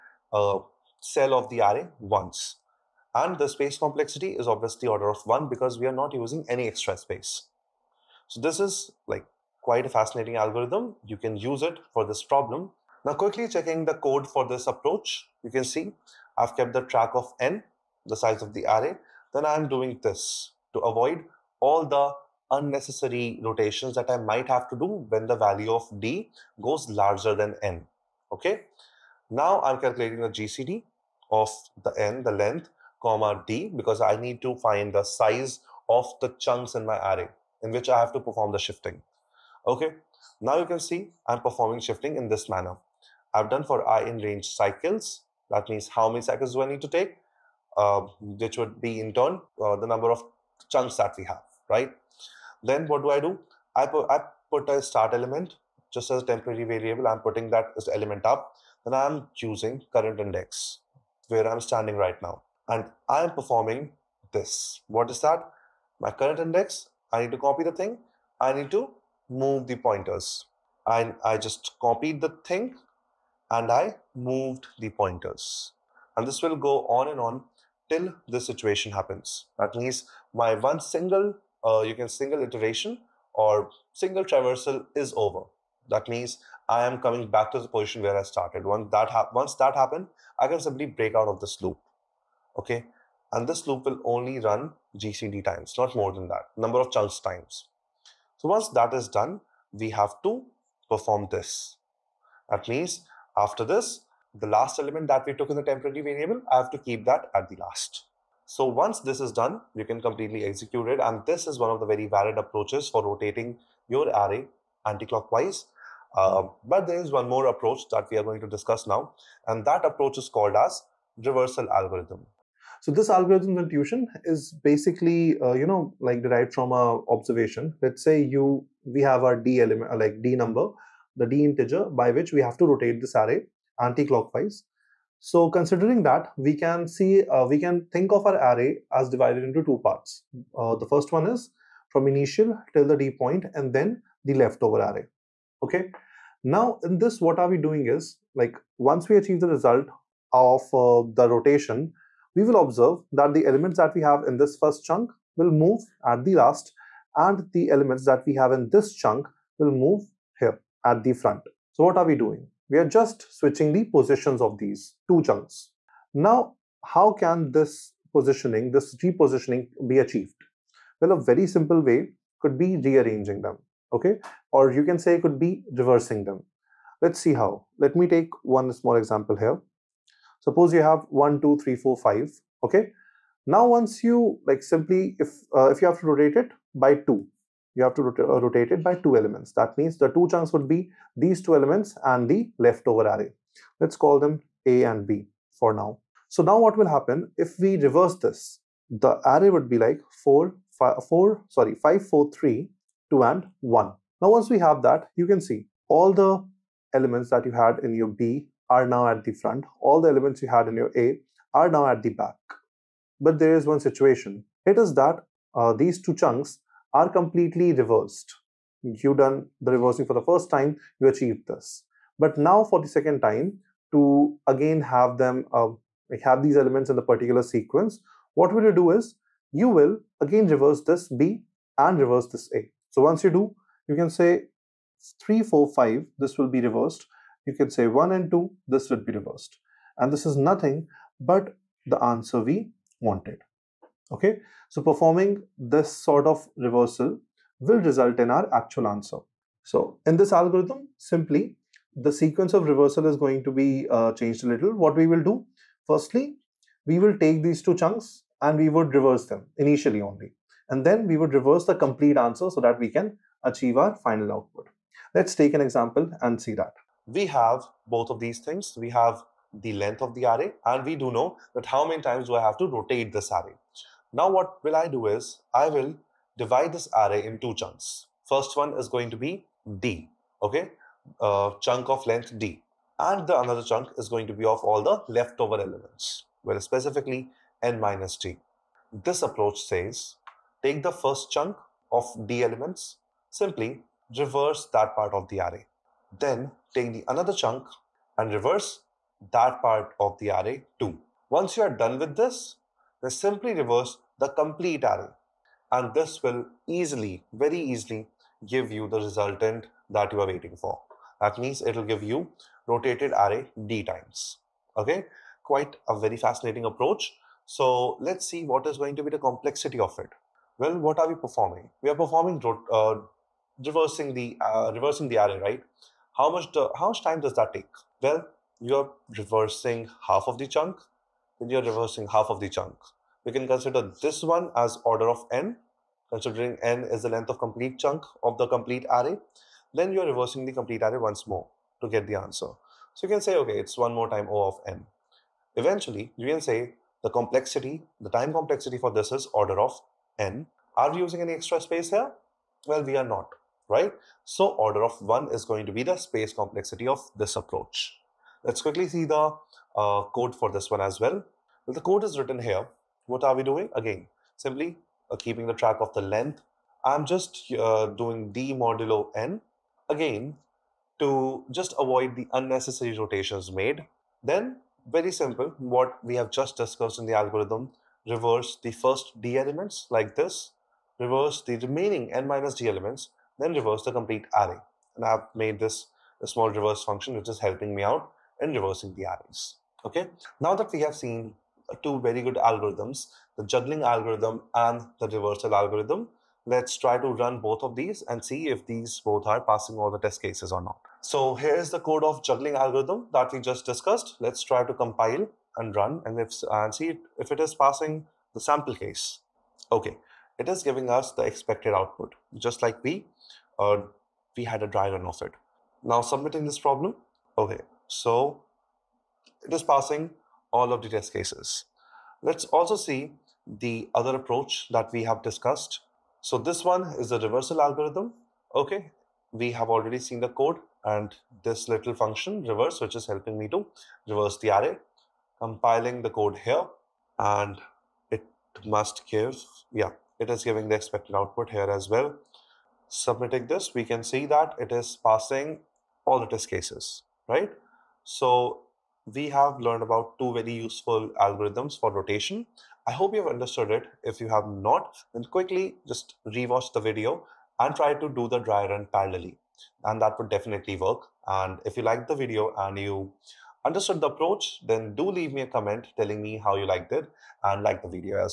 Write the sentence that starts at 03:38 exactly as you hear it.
You done the reversing for the first time, you achieved this.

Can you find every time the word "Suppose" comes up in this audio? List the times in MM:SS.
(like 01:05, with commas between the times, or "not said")
03:00.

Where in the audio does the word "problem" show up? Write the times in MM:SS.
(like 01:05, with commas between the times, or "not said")
00:12, 06:56.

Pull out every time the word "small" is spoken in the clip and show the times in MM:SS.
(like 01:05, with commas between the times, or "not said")
02:58, 06:26.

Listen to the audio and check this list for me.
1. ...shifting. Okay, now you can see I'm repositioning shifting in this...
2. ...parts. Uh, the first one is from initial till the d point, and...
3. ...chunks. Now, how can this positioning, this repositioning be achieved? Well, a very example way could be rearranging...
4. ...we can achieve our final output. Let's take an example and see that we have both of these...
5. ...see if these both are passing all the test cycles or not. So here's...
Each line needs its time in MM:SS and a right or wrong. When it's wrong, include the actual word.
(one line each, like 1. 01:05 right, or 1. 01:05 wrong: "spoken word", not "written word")
1. 00:38 wrong: "performing", not "repositioning"
2. 02:19 right
3. 02:45 wrong: "simple", not "example"
4. 04:22 right
5. 06:38 wrong: "cases", not "cycles".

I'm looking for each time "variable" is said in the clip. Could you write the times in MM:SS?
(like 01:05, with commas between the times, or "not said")
00:56, 01:46.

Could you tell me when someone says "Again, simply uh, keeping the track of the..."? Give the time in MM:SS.
06:03.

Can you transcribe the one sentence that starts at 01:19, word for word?
That means my one single, uh, you can single iteration or single traversal is over.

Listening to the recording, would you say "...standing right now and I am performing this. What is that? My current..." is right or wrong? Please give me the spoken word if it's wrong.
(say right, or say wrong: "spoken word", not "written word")
right.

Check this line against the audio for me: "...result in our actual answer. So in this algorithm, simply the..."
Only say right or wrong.
right.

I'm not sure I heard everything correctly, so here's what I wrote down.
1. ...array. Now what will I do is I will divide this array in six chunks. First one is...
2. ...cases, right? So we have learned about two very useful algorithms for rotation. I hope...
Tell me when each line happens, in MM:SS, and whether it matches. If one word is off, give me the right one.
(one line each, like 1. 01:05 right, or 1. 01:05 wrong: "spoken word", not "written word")
1. 04:33 wrong: "two", not "six"
2. 07:26 right.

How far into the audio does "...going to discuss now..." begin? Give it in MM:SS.
01:58.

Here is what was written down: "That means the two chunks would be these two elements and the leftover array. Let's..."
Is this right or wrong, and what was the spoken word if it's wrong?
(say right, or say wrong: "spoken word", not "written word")
right.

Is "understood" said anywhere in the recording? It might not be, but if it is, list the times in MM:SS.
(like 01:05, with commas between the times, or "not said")
07:33, 07:43.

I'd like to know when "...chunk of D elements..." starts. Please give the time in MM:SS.
04:51.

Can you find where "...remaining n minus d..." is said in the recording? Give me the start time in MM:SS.
06:21.